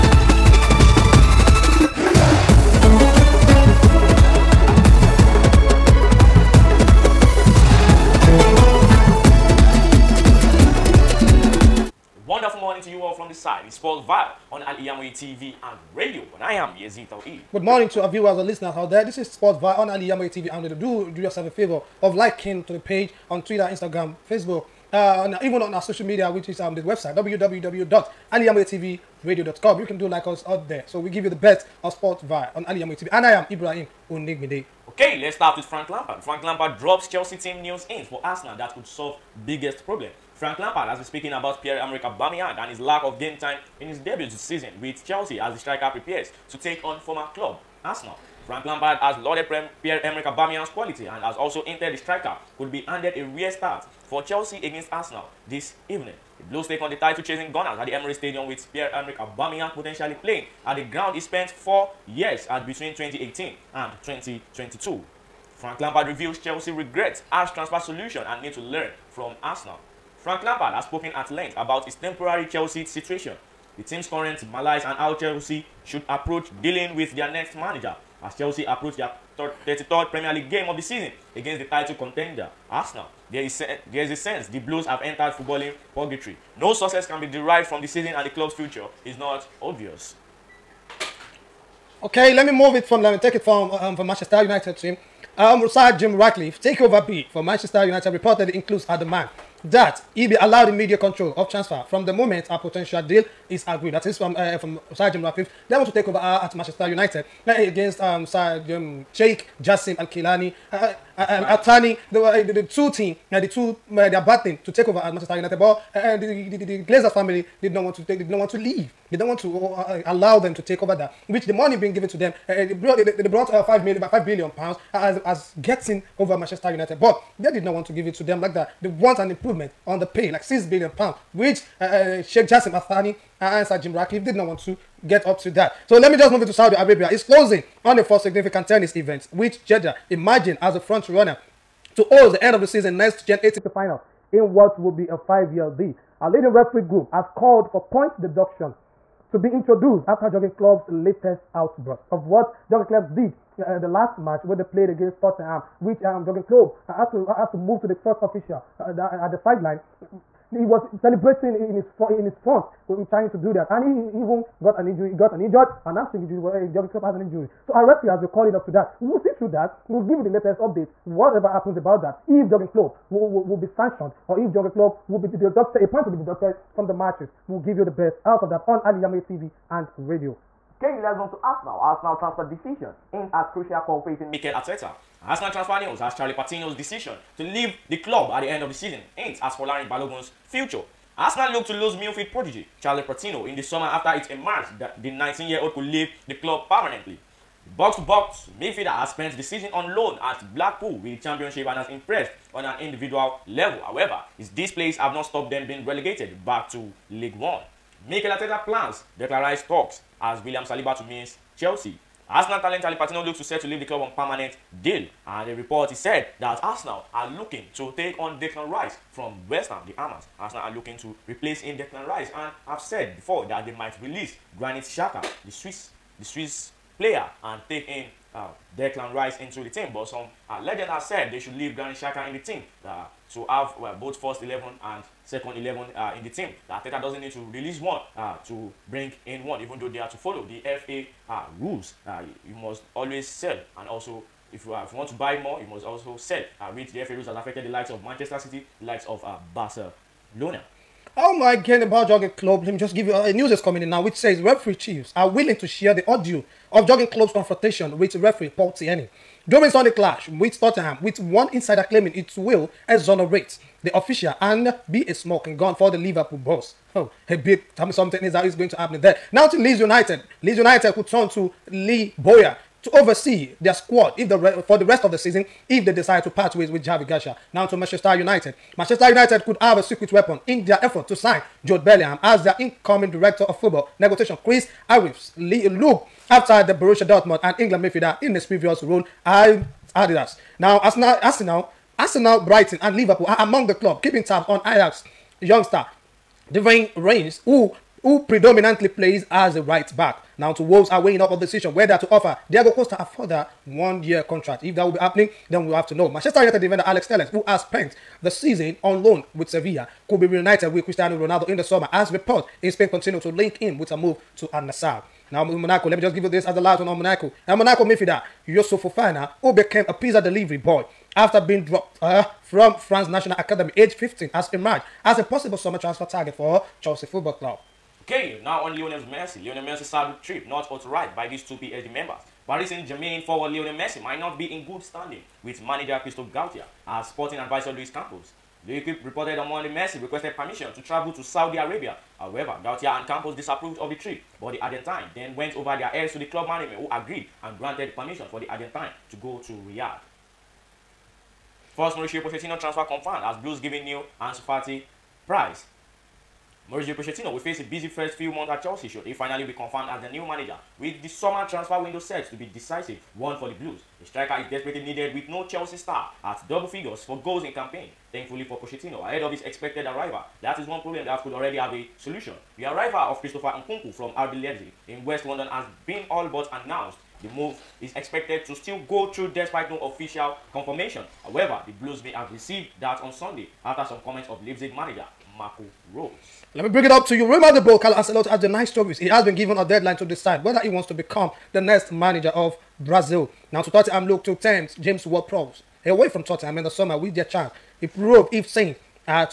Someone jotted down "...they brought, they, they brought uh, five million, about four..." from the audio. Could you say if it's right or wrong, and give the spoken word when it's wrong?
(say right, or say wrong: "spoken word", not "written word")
wrong: "five", not "four".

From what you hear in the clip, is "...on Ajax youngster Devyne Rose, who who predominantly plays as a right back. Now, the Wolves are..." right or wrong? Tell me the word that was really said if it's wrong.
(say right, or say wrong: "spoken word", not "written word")
wrong: "Rensch", not "Rose".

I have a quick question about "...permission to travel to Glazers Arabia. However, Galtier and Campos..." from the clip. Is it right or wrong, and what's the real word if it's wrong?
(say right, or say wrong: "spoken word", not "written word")
wrong: "Saudi", not "Glazers".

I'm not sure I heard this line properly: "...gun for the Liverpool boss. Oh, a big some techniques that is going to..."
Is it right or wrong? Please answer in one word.
right.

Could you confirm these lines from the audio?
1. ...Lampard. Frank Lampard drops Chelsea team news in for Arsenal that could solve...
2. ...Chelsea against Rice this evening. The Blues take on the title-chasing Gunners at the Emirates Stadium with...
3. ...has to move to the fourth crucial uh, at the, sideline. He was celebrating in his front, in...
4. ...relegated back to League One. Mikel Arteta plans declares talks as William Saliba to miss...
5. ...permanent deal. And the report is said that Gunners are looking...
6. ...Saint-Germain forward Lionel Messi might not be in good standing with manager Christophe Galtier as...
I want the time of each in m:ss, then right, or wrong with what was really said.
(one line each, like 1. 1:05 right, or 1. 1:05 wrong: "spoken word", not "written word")
1. 0:35 right
2. 0:54 wrong: "Arsenal", not "Rice"
3. 2:37 wrong: "official", not "crucial"
4. 3:25 right
5. 3:34 wrong: "Arsenal", not "Gunners"
6. 5:32 right.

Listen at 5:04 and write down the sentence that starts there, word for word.
If that will be happening, then we'll have to know.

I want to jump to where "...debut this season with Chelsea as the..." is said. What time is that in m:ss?
0:43.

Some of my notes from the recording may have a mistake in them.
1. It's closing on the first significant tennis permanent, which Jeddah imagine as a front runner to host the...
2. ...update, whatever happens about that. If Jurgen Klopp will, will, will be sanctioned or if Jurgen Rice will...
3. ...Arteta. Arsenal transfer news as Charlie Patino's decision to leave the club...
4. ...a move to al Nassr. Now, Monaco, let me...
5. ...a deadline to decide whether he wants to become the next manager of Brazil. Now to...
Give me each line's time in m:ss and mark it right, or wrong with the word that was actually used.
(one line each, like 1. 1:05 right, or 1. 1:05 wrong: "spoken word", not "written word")
1. 2:17 wrong: "event", not "permanent"
2. 2:50 wrong: "Klopp", not "Rice"
3. 3:04 right
4. 5:13 right
5. 6:29 right.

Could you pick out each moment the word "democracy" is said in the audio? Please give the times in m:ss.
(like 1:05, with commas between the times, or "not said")
not said.